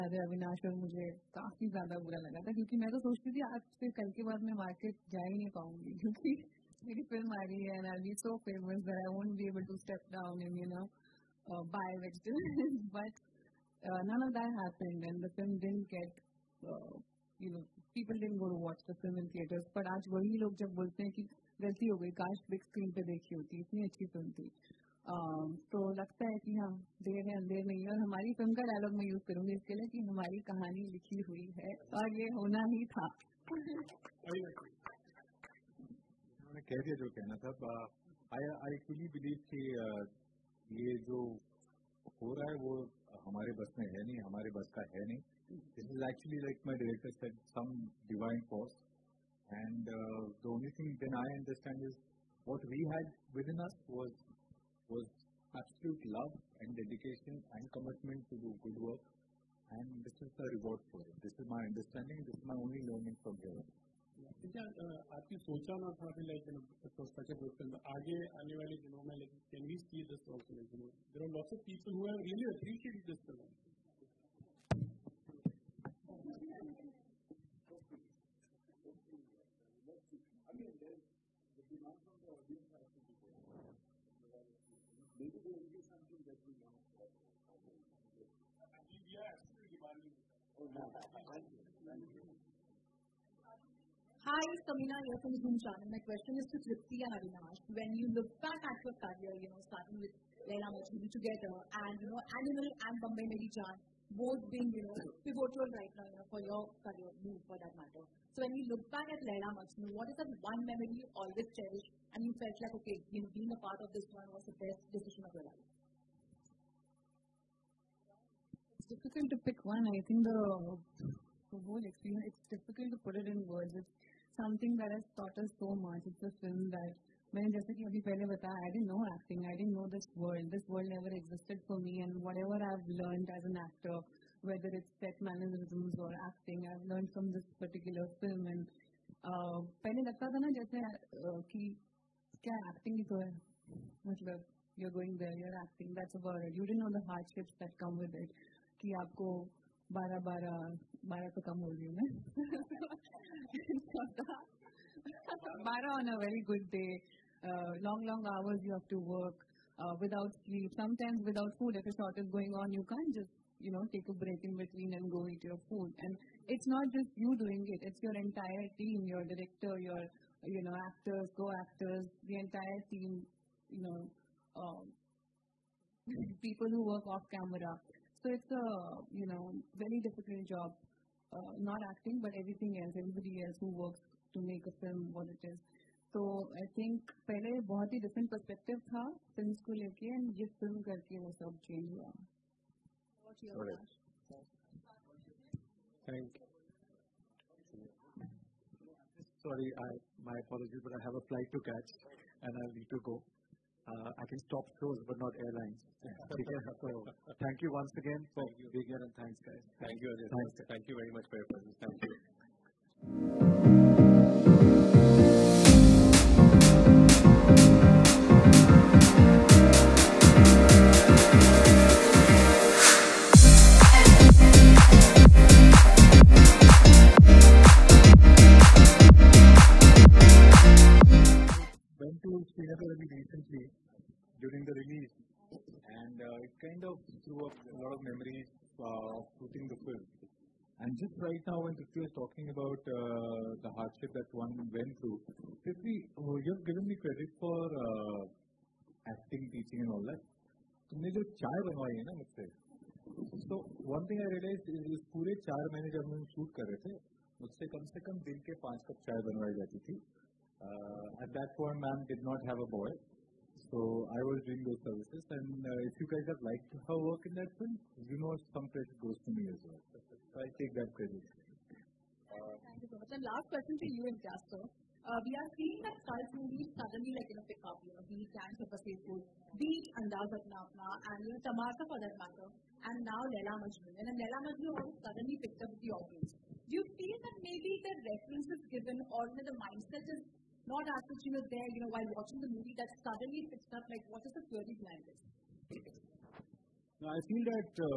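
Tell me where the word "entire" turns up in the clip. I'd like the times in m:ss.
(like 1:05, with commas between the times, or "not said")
2:48, 2:52.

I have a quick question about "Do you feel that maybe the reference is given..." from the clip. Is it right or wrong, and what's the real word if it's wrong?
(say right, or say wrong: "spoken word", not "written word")
right.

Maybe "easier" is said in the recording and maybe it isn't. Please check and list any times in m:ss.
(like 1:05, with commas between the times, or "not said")
not said.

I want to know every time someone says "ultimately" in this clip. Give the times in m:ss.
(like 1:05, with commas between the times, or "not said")
not said.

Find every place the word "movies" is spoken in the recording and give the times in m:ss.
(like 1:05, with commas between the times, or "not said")
4:36, 4:52.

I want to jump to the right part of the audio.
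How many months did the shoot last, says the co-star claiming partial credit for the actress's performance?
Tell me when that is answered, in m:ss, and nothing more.
4:15.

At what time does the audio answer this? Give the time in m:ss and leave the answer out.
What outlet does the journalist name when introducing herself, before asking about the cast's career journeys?
1:35.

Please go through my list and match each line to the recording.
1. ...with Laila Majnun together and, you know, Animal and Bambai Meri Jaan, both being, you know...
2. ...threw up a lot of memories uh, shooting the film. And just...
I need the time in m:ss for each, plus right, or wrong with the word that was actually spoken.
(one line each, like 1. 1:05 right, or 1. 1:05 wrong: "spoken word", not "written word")
1. 1:40 right
2. 3:57 right.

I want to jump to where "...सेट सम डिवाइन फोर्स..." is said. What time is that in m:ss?
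0:47.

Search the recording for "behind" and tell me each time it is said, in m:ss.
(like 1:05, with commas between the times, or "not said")
4:54.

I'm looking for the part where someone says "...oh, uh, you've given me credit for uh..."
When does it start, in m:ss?
4:06.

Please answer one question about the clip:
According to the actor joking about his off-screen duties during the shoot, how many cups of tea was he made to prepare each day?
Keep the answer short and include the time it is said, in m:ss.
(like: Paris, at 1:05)
5, at 4:18.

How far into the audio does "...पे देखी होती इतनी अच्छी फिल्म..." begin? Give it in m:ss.
0:23.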